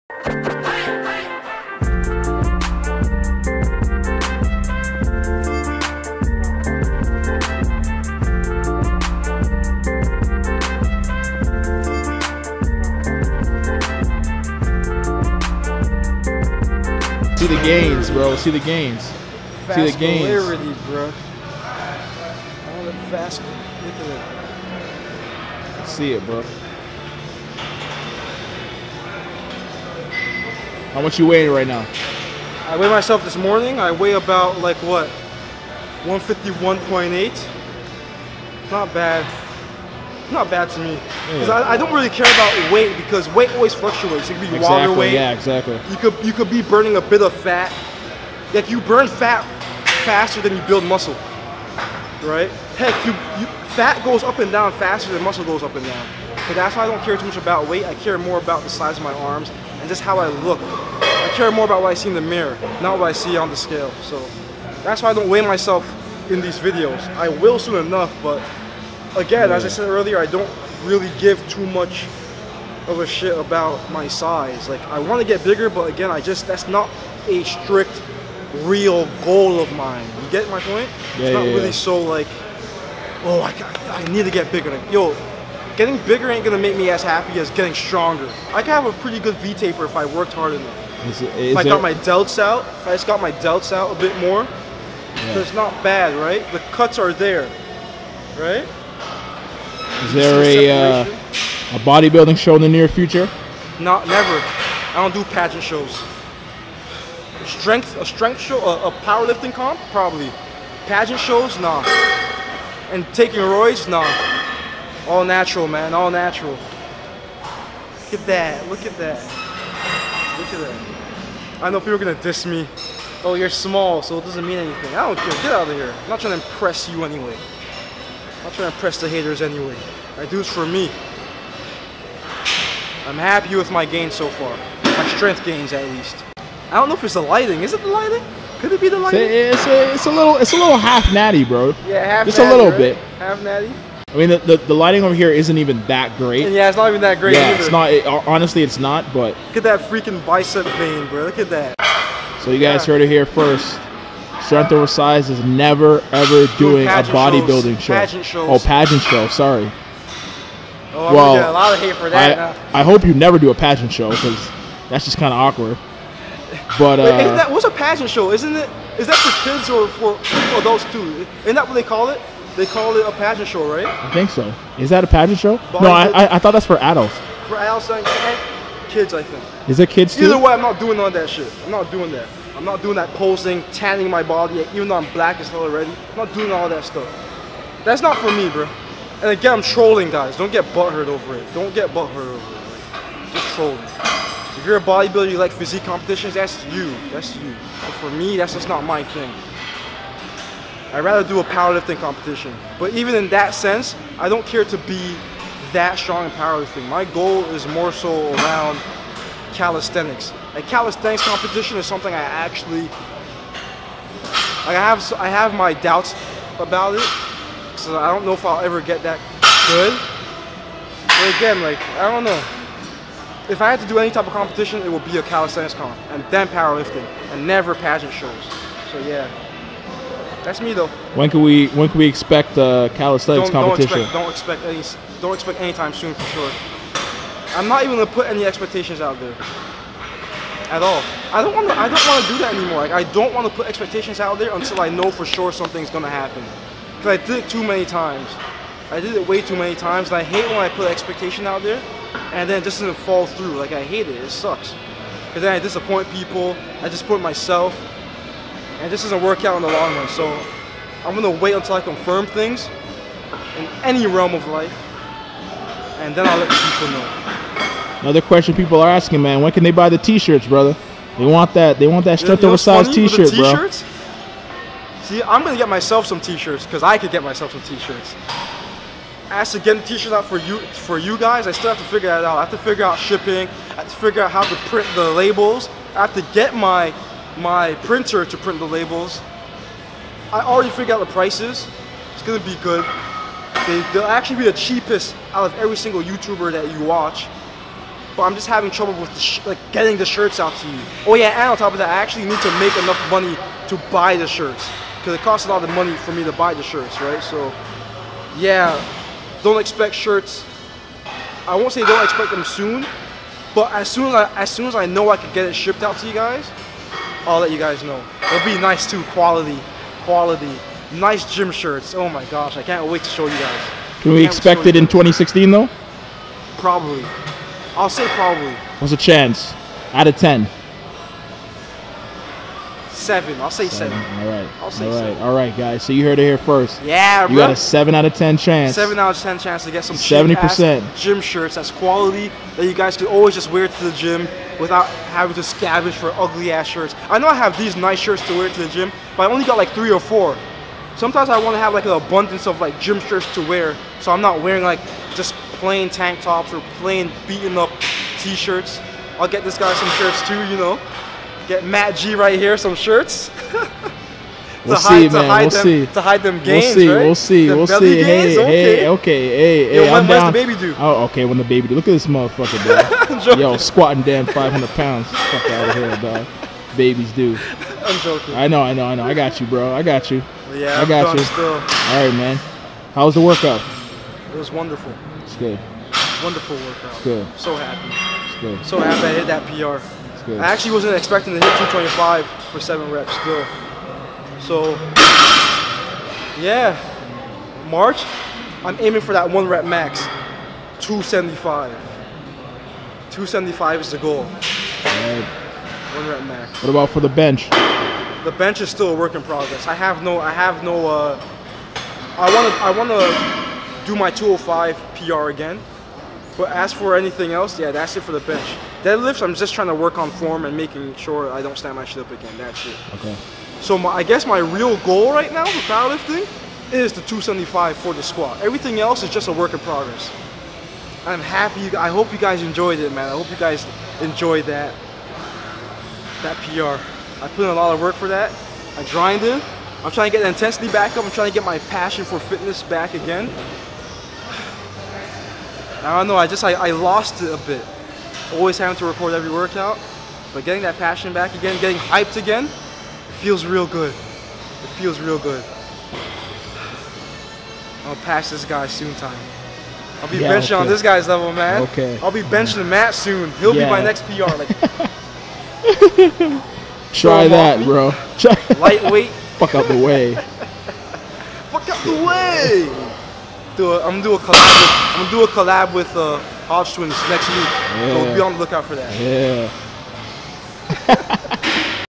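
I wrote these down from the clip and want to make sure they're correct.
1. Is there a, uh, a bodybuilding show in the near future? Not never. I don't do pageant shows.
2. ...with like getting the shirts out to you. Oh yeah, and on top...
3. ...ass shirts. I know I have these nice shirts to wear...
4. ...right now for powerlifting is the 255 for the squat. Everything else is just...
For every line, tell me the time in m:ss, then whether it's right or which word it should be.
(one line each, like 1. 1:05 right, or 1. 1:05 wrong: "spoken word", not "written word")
1. 1:40 right
2. 4:58 right
3. 5:46 right
4. 7:05 wrong: "275", not "255".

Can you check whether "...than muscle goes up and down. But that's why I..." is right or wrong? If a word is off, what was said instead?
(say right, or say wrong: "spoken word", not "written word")
right.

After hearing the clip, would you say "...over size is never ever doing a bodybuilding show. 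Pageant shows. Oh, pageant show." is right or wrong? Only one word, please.
right.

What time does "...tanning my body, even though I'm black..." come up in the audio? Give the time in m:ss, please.
3:03.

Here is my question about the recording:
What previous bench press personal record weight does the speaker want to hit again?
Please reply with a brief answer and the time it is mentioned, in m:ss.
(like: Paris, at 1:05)
205, at 6:54.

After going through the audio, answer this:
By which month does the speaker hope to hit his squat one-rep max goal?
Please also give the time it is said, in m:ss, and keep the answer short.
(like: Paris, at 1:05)
March, at 6:37.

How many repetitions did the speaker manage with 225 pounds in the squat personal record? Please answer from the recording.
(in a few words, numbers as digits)
7.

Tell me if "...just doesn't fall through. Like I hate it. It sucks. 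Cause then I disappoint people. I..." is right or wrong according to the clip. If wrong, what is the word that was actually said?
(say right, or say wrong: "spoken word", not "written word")
right.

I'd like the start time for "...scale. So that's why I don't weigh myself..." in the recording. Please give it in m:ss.
1:03.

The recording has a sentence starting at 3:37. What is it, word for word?
So I don't know if I'll ever get that good.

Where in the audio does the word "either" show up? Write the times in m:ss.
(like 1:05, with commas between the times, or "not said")
2:27, 3:00.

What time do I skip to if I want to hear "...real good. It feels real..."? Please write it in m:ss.
7:33.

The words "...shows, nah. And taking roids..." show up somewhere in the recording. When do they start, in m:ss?
1:51.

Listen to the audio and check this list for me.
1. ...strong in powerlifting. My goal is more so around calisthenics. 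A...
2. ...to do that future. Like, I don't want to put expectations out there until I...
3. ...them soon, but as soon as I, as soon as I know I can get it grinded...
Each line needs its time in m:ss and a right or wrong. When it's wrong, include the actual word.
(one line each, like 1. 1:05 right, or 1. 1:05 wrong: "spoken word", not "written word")
1. 3:25 right
2. 4:02 wrong: "anymore", not "future"
3. 5:12 wrong: "shipped", not "grinded".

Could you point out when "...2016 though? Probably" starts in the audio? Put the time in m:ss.
5:24.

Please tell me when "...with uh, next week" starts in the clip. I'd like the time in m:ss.
7:55.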